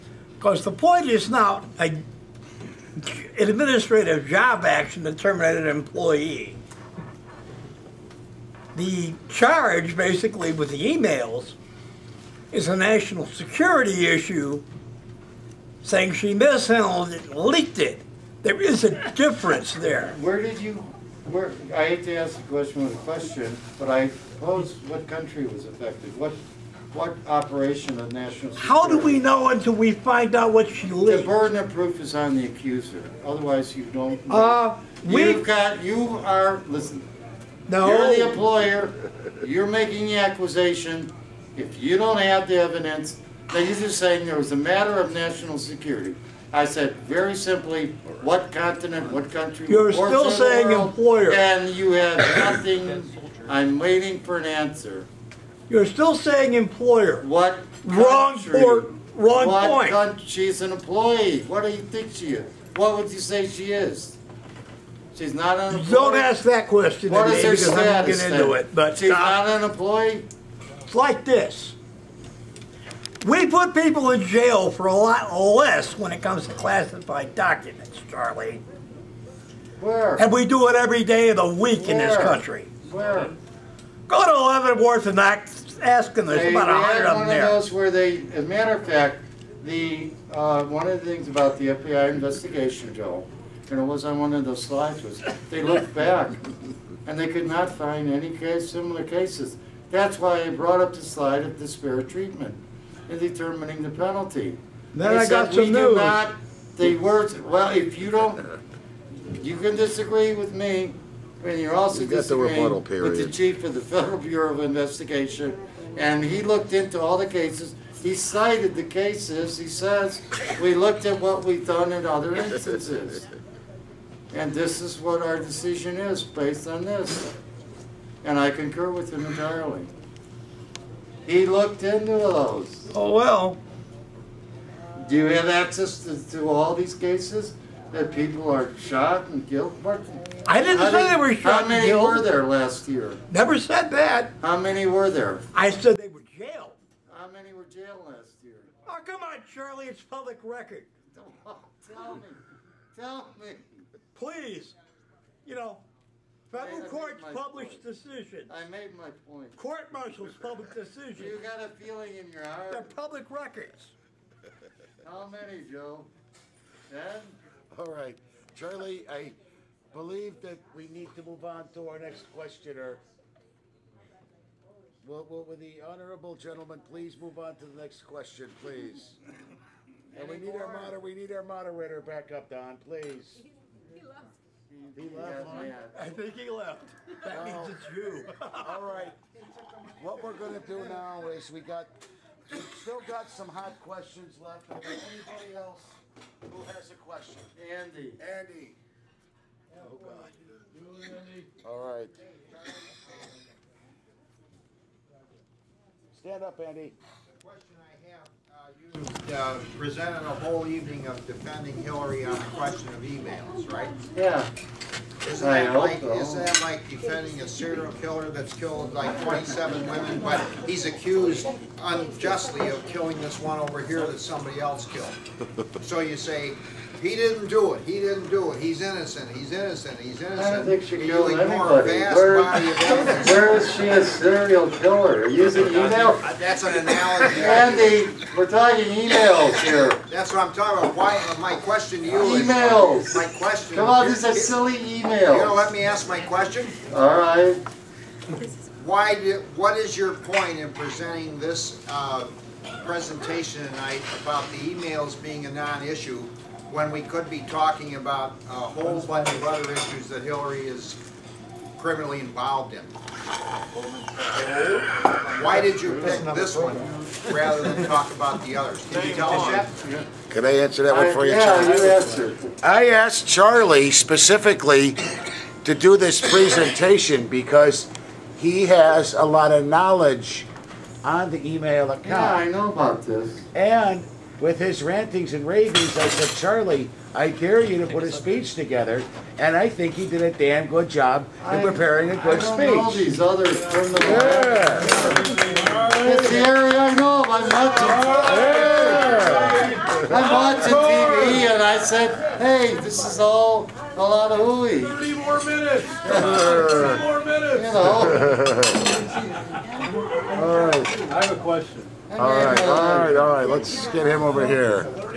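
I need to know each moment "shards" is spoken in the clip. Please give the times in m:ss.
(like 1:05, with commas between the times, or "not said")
not said.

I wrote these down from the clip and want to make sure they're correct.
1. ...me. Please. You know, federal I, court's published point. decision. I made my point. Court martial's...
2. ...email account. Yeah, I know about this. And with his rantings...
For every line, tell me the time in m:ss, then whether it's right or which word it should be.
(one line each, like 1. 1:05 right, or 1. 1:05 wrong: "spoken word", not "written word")
1. 2:33 right
2. 4:41 right.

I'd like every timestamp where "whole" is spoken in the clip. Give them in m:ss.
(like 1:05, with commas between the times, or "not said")
3:30, 4:18.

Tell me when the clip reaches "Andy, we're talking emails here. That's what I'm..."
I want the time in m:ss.
3:57.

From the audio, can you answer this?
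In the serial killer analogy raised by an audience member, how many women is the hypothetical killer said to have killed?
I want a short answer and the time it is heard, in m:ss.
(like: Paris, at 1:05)
27, at 3:39.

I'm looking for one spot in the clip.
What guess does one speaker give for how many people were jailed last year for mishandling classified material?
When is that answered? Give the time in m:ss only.
2:46.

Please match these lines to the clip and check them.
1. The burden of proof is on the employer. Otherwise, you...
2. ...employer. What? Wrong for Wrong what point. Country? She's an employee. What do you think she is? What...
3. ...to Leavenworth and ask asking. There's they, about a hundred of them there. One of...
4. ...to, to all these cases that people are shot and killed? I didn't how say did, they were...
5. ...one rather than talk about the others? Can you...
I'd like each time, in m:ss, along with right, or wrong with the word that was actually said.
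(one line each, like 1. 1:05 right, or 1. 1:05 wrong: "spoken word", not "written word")
1. 0:31 wrong: "accuser", not "employer"
2. 0:56 right
3. 1:24 right
4. 2:16 right
5. 4:26 right.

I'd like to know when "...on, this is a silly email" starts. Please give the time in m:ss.
4:03.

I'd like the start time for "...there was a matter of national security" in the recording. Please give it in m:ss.
0:44.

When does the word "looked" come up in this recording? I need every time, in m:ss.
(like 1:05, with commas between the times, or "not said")
1:35, 1:56, 2:00, 2:11.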